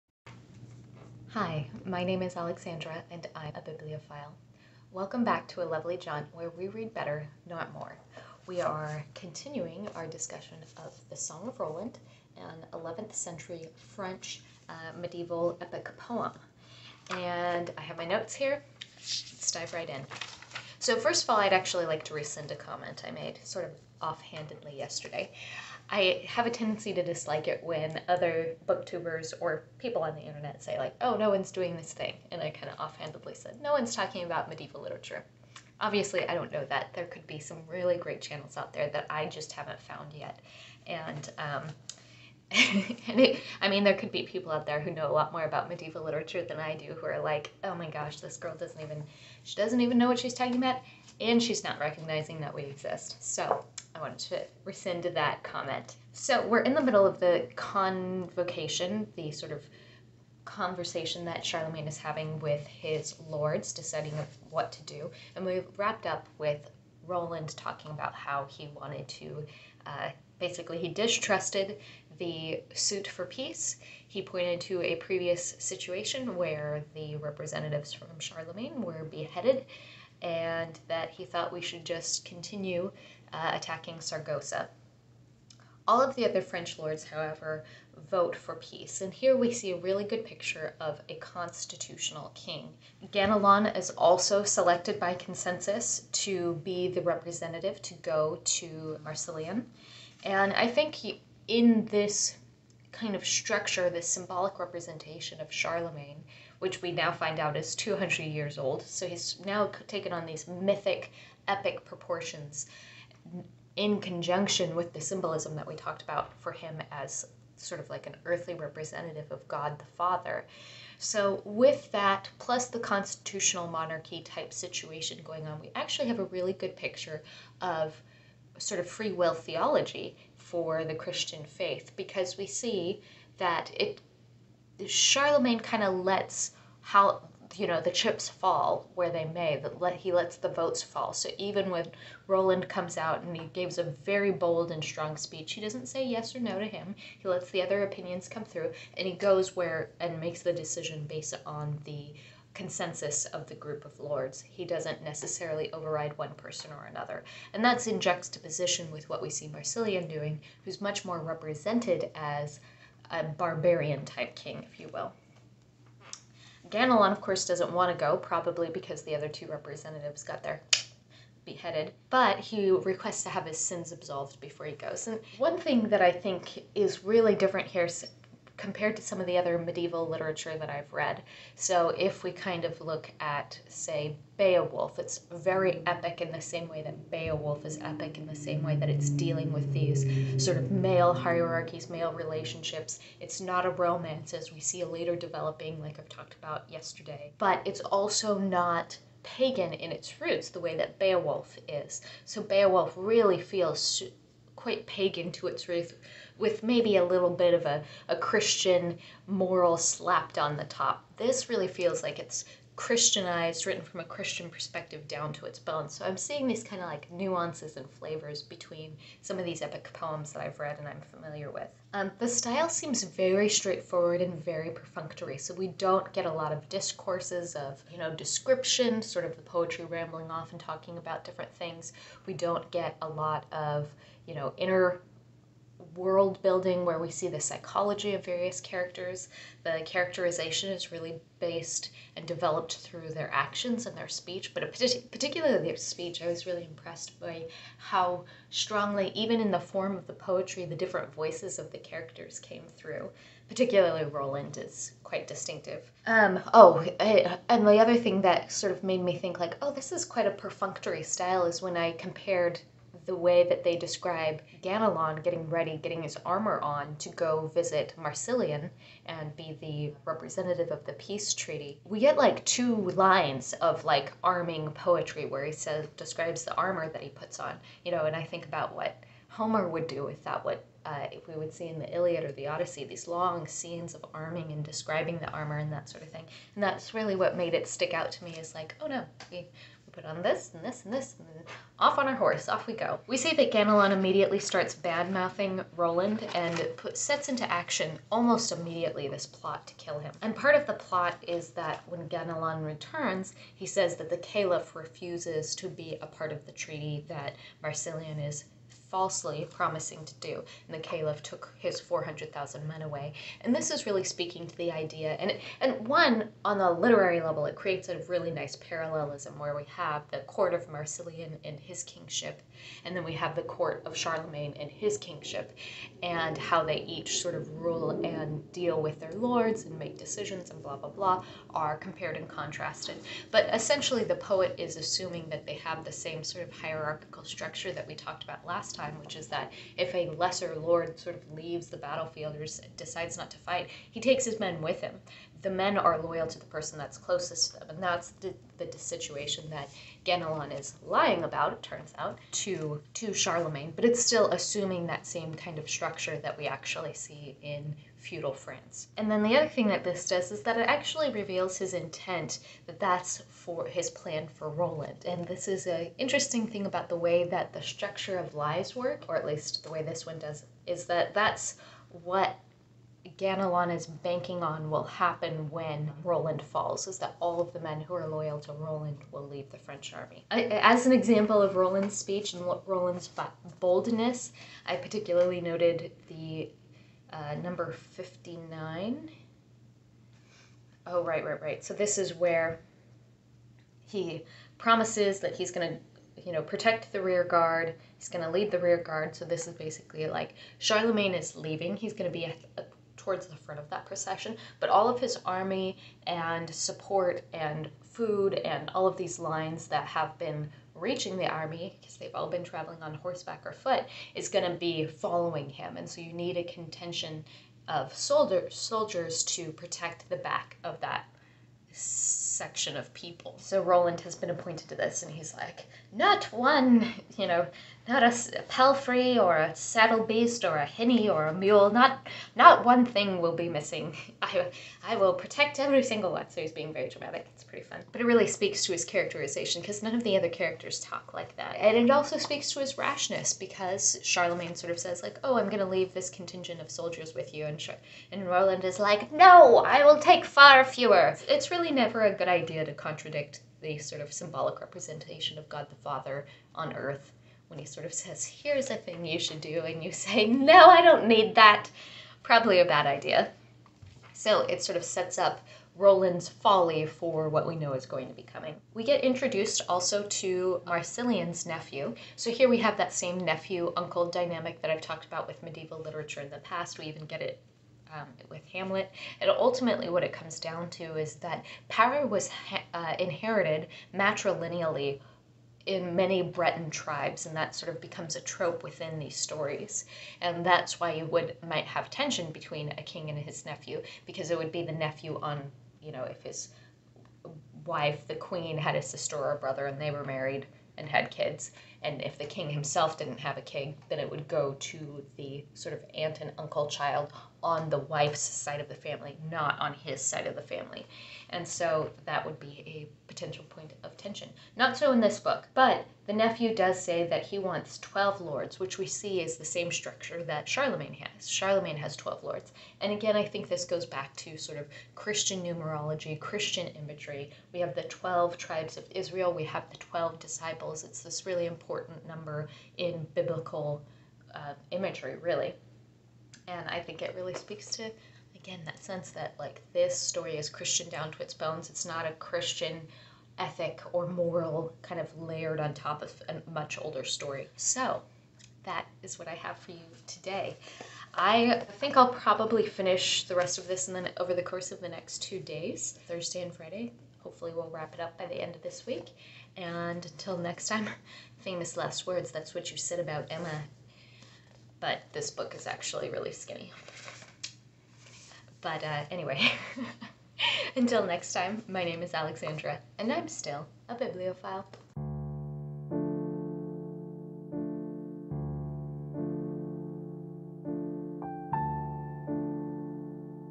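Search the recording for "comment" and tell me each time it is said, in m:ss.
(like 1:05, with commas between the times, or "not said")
0:22, 0:55.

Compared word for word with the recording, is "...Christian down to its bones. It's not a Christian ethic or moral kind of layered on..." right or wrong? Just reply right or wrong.
right.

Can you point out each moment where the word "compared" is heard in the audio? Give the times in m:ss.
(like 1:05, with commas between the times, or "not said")
2:58, 4:21, 5:31.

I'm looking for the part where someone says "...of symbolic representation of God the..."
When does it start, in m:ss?
7:34.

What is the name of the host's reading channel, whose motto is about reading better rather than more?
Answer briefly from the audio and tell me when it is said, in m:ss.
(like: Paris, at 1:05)
A Lovely Jaunt, at 0:05.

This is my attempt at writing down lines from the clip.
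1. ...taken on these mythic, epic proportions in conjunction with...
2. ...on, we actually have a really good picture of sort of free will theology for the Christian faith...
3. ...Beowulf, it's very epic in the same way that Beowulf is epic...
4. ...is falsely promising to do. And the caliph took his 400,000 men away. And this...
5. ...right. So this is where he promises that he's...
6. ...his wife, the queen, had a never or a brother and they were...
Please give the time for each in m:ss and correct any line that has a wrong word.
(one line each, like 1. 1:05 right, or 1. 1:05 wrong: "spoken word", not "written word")
1. 1:49 right
2. 2:05 right
3. 3:04 right
4. 5:08 right
5. 6:31 right
6. 8:16 wrong: "sister", not "never".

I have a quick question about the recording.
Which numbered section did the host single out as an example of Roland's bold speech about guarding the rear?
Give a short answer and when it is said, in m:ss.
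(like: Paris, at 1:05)
59, at 6:27.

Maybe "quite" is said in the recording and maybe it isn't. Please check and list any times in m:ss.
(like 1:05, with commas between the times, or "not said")
3:24, 4:15, 4:20.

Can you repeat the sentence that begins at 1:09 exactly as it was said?
Uh, basically, he distrusted the suit for peace.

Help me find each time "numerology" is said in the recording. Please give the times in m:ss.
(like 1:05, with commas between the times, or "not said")
8:45.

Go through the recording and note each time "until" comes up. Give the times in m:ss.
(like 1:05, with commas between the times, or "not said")
9:20, 9:30.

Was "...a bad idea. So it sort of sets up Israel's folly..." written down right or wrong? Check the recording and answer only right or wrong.
wrong.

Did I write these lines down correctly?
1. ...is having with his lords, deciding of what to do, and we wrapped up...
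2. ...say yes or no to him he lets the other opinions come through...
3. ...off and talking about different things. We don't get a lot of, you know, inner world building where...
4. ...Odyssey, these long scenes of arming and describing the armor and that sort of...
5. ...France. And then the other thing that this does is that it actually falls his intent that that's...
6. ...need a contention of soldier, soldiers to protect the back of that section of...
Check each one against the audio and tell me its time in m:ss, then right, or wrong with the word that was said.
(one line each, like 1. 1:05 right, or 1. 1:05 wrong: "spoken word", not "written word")
1. 1:01 right
2. 2:25 right
3. 3:50 right
4. 4:42 right
5. 5:58 wrong: "reveals", not "falls"
6. 6:56 right.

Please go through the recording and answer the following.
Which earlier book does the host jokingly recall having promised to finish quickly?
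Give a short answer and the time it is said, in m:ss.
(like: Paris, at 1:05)
Emma, at 9:23.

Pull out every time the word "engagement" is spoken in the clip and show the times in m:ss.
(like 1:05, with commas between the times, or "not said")
not said.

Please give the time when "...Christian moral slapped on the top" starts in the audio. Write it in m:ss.
3:28.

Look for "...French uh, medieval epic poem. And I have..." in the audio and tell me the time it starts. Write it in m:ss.
0:13.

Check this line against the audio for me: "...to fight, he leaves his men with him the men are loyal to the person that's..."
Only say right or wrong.
wrong.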